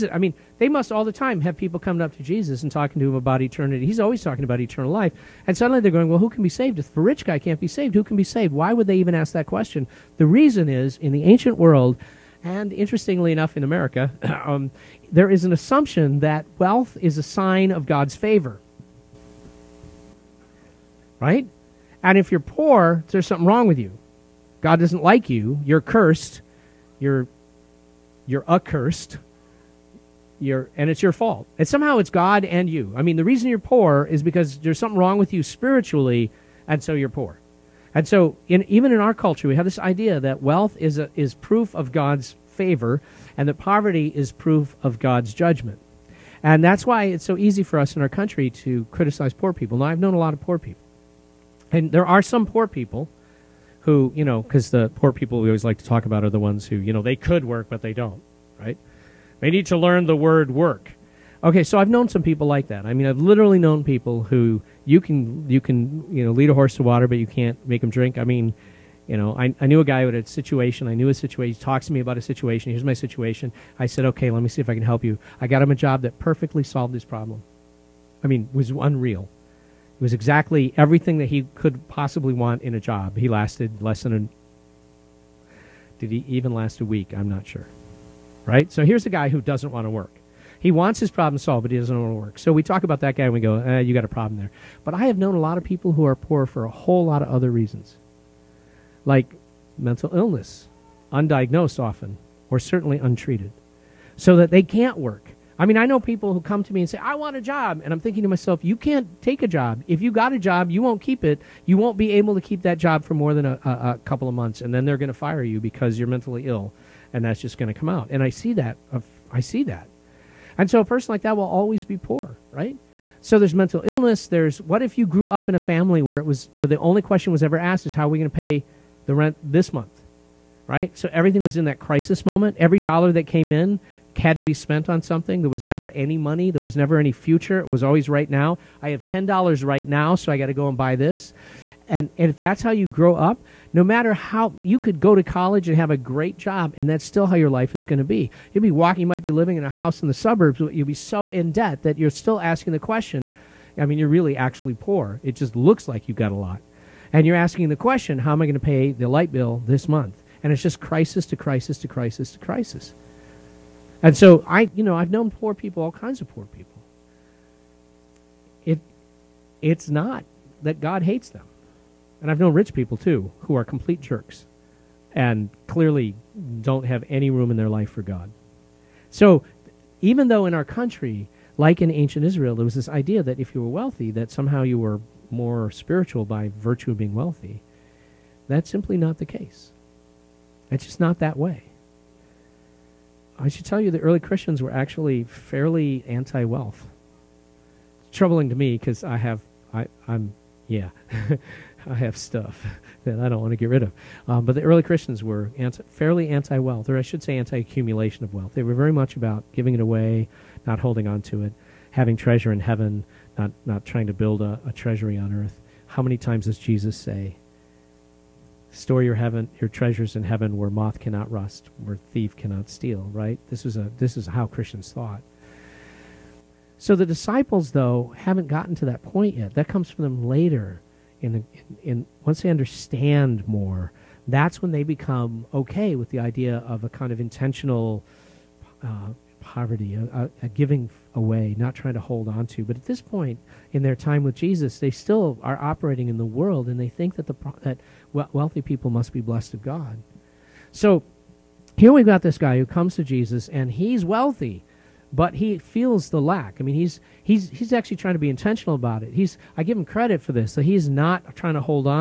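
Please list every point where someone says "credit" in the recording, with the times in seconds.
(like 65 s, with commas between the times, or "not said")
259 s.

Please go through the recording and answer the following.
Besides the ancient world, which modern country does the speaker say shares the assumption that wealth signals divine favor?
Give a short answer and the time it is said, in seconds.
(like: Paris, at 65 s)
America, at 13 s.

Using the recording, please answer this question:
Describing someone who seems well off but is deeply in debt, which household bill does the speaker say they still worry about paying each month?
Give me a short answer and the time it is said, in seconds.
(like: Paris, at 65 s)
The light bill, at 159 s.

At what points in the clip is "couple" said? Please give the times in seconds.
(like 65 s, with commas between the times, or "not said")
114 s.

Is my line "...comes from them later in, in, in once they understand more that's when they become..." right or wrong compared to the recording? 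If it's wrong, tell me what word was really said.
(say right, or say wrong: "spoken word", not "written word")
right.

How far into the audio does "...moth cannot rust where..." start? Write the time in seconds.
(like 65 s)
220 s.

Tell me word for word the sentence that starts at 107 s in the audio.
And I'm thinking to myself, you can't take a job.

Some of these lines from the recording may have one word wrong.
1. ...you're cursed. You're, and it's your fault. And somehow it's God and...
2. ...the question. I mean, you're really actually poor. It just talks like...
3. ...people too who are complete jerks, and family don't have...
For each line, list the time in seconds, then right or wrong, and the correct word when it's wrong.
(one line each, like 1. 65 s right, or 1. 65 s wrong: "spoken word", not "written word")
1. 28 s wrong: "accursed", not "cursed"
2. 152 s wrong: "looks", not "talks"
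3. 172 s wrong: "clearly", not "family".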